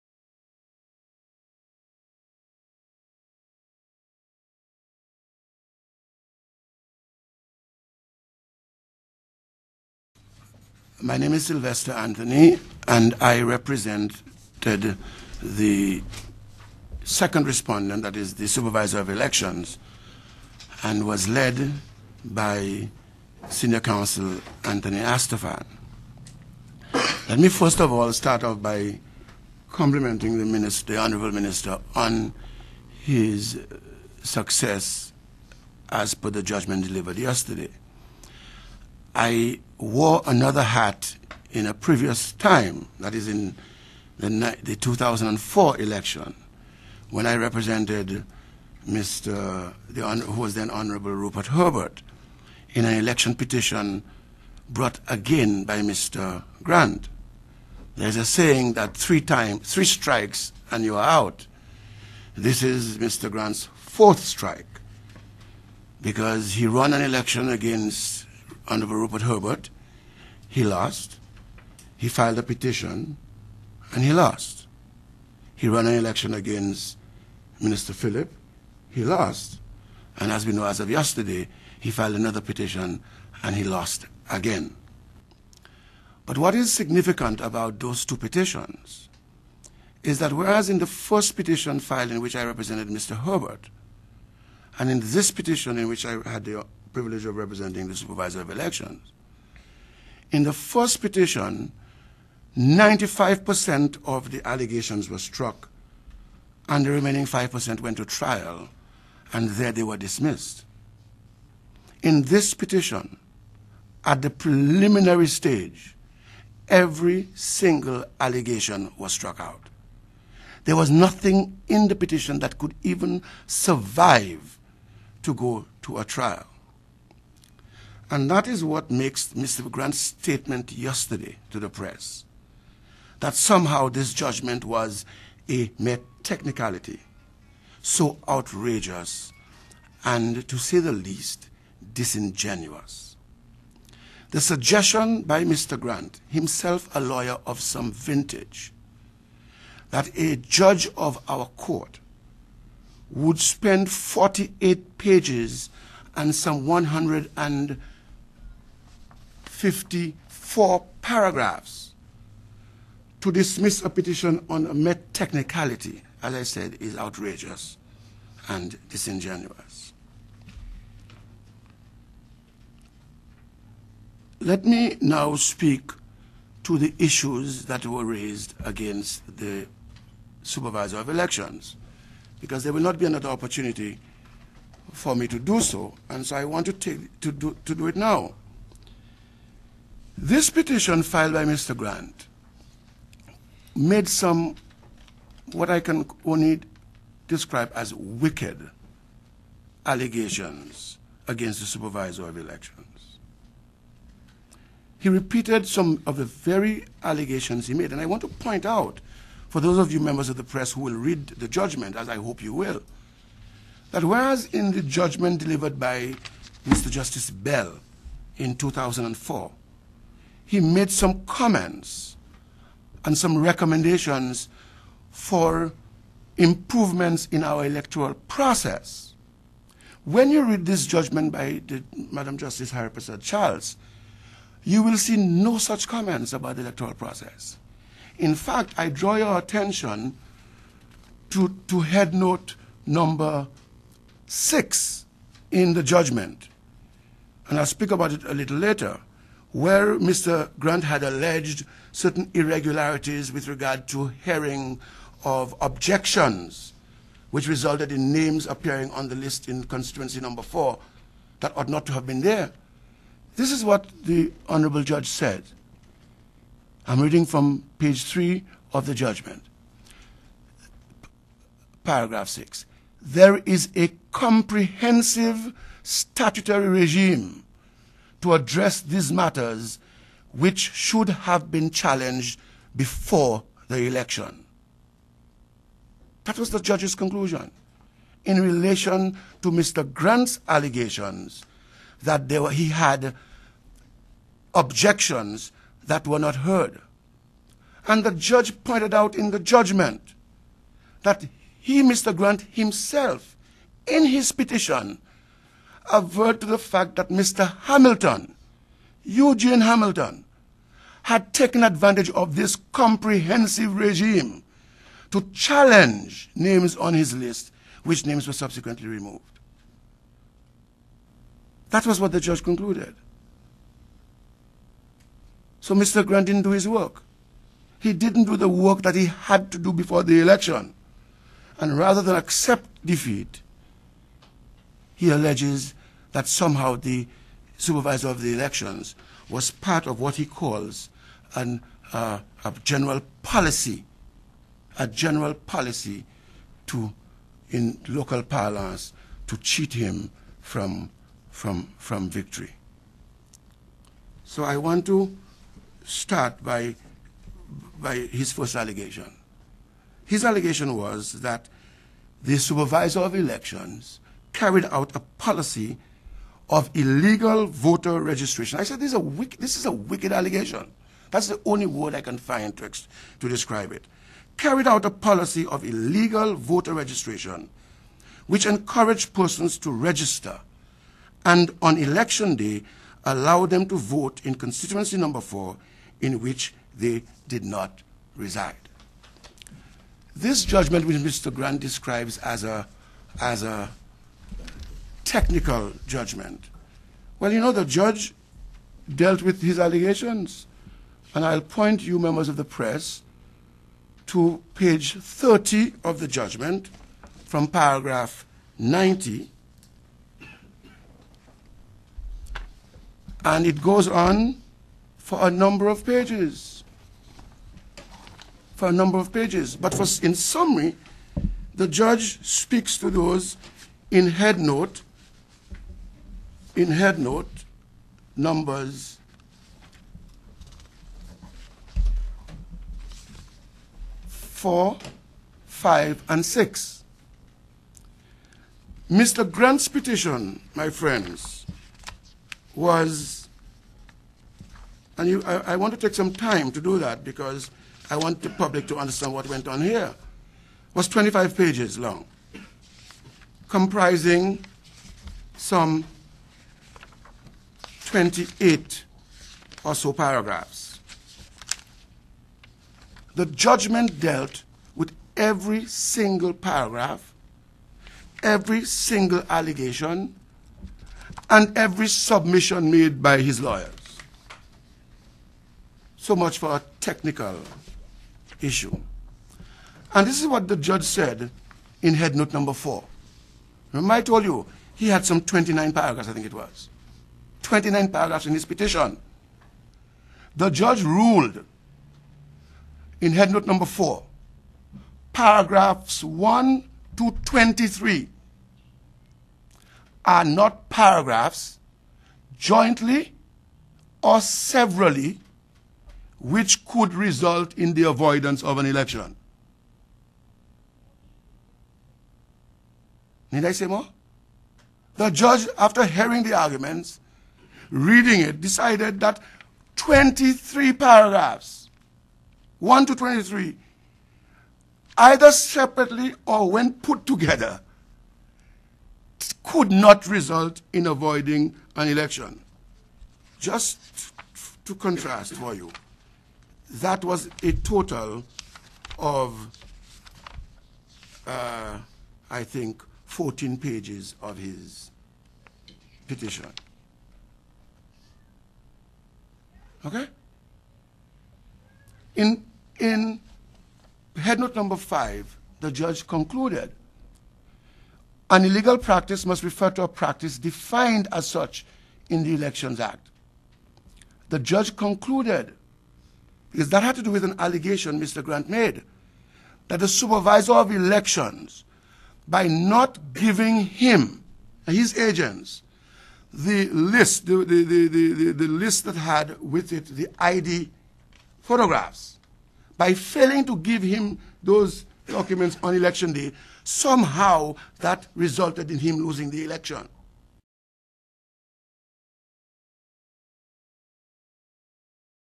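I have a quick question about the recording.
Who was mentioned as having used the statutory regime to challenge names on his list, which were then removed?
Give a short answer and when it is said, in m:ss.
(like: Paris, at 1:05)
Eugene Hamilton, at 5:09.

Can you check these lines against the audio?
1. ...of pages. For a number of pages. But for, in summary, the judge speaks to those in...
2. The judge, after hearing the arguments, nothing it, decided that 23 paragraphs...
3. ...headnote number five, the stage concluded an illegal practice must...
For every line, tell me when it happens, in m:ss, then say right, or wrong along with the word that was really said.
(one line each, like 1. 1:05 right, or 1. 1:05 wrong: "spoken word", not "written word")
1. 6:55 right
2. 8:34 wrong: "reading", not "nothing"
3. 9:14 wrong: "judge", not "stage".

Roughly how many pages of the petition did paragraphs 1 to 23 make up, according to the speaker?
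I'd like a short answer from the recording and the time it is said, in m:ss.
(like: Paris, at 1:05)
14, at 9:03.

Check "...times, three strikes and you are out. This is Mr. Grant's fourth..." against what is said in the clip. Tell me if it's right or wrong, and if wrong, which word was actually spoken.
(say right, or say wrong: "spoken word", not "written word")
right.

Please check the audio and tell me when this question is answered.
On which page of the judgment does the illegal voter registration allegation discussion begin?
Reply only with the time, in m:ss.
6:44.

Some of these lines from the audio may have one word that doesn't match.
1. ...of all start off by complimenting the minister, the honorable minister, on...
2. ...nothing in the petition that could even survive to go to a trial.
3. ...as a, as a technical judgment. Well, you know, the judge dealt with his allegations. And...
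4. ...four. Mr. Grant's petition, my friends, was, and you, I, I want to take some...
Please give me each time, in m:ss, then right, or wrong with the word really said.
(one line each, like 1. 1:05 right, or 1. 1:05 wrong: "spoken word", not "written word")
1. 0:27 right
2. 2:00 right
3. 6:32 right
4. 7:16 wrong: "six", not "four".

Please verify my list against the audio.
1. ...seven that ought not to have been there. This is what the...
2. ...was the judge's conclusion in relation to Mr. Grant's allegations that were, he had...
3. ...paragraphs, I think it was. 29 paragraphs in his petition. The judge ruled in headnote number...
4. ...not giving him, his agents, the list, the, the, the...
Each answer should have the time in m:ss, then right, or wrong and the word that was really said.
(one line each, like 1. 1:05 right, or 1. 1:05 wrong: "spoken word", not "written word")
1. 4:20 wrong: "four", not "seven"
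2. 4:46 right
3. 8:05 right
4. 9:32 right.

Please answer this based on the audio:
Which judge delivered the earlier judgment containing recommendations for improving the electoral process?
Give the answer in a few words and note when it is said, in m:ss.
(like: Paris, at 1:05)
Mr. Justice Bell, at 3:36.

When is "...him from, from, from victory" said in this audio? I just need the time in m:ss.
5:49.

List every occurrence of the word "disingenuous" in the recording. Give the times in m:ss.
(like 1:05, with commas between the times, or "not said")
2:21, 2:48.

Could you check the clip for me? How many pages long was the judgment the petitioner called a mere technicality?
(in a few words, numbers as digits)
48.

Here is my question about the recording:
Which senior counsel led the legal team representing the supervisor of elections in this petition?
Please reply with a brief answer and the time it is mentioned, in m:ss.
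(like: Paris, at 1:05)
Anthony Astaphan, at 0:24.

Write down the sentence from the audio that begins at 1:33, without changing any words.
Herbert, and in this petition in which I had the privilege of representing the supervisor of elections.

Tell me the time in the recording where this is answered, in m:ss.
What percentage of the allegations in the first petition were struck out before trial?
1:42.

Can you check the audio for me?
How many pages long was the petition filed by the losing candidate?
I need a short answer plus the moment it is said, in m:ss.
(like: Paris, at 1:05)
25, at 7:30.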